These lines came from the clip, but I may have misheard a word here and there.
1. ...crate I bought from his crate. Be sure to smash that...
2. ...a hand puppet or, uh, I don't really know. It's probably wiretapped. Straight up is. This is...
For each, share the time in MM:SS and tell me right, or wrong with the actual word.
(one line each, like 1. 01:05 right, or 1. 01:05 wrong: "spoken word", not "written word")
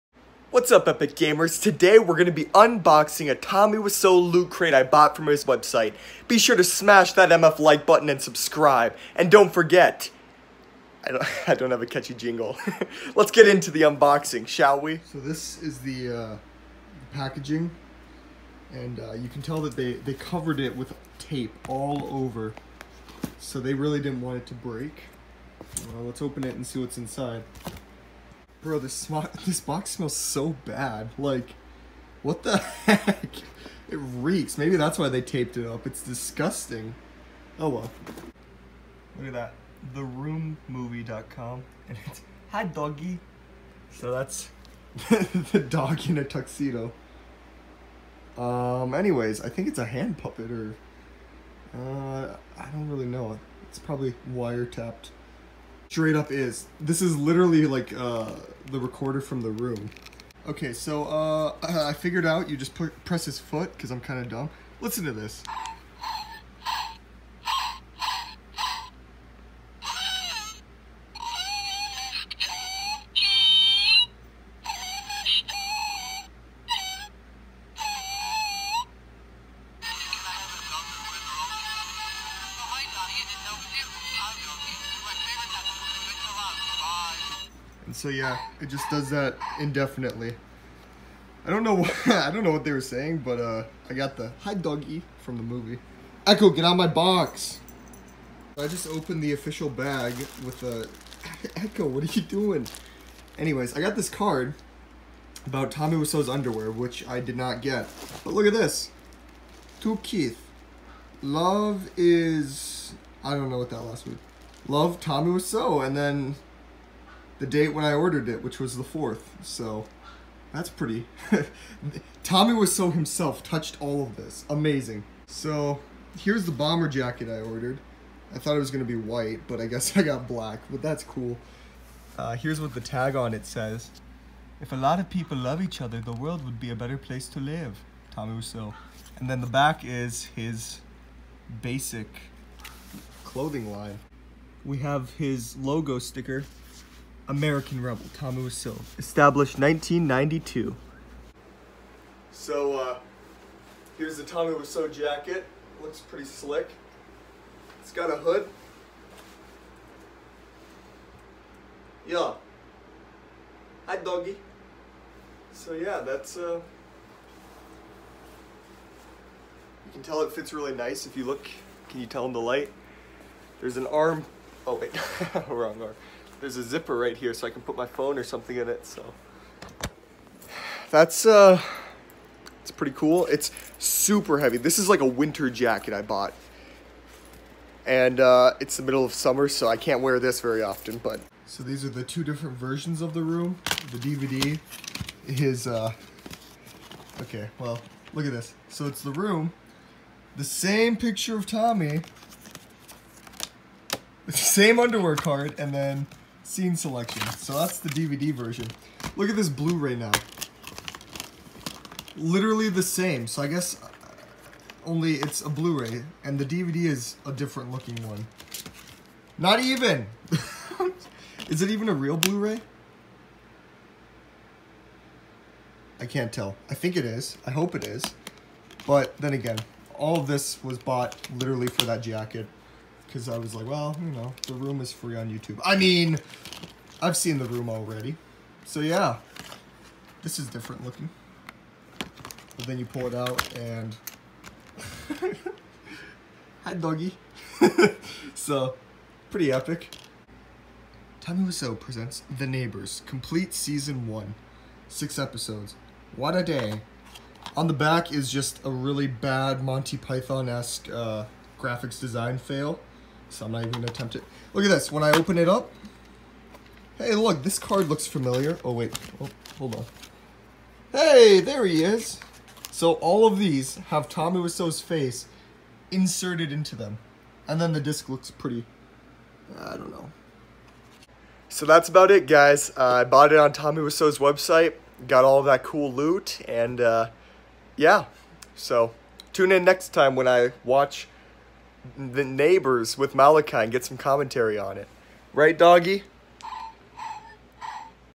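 1. 00:04 wrong: "website", not "crate"
2. 00:49 right.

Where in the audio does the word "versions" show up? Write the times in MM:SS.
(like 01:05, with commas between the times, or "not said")
03:12, 03:28.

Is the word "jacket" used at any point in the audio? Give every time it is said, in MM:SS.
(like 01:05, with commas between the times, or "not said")
02:06, 02:34, 03:05, 03:52.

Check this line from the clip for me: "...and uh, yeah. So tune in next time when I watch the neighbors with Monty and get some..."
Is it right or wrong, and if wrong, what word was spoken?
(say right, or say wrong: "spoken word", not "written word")
wrong: "Malachi", not "Monty".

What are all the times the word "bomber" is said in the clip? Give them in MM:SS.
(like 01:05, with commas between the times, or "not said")
02:06.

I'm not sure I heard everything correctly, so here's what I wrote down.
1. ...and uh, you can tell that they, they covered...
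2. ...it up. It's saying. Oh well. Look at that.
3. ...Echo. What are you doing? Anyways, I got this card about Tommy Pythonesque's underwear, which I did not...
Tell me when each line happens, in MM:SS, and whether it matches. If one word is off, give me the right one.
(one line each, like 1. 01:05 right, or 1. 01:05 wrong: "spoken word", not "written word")
1. 00:18 right
2. 00:35 wrong: "disgusting", not "saying"
3. 01:41 wrong: "Wiseau", not "Pythonesque".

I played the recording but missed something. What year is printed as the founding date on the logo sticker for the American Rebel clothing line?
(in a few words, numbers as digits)
1992.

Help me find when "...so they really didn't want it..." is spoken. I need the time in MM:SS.
00:23.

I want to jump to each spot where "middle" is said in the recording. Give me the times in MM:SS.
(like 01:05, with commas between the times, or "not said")
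03:08.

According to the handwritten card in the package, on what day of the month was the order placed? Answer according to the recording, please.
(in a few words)
4th.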